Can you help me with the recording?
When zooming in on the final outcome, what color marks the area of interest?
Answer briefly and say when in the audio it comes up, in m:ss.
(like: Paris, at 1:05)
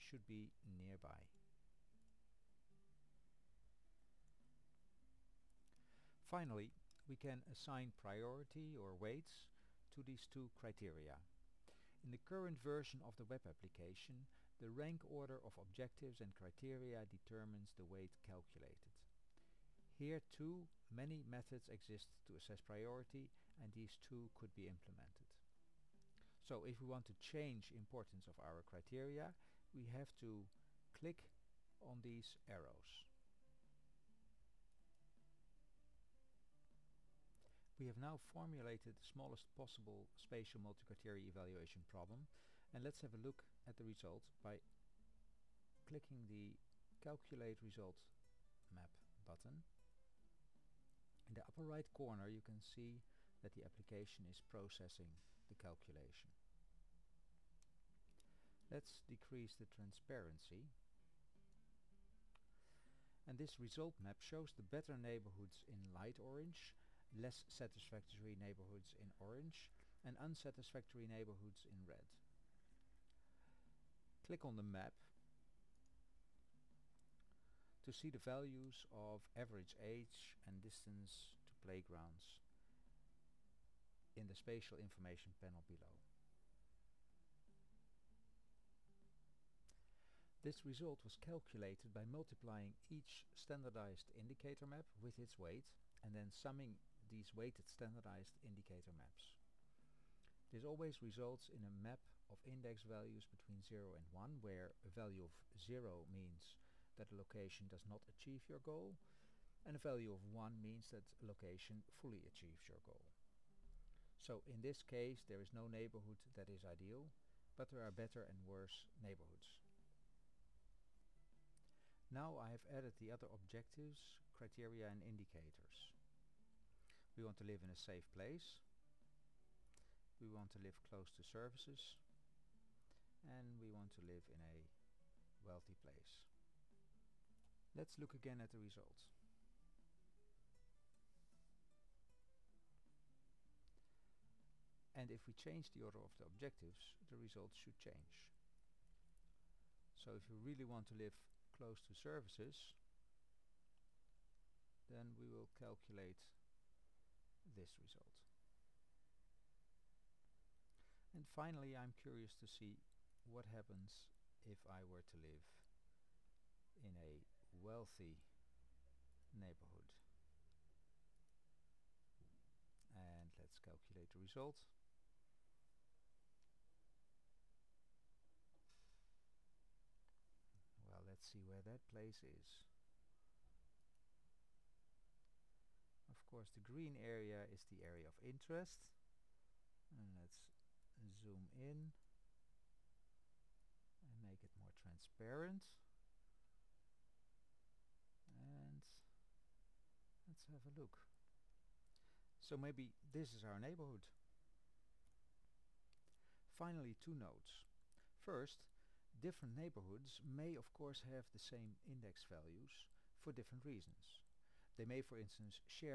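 Green, at 3:06.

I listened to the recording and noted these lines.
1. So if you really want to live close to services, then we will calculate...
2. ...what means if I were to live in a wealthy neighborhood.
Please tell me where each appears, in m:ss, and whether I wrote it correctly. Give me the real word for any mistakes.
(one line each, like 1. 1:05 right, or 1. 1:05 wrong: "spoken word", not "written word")
1. 2:29 right
2. 2:43 wrong: "happens", not "means".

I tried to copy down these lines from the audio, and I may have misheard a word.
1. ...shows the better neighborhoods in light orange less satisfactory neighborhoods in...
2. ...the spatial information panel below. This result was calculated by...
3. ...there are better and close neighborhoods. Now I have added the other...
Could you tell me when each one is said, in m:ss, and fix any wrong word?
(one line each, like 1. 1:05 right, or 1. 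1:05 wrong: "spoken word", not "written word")
1. 1:04 right
2. 1:24 right
3. 1:57 wrong: "worse", not "close".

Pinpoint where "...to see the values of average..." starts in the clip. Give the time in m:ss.
1:17.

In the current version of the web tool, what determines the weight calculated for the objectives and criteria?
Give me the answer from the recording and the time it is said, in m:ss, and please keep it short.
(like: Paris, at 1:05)
Rank order, at 0:14.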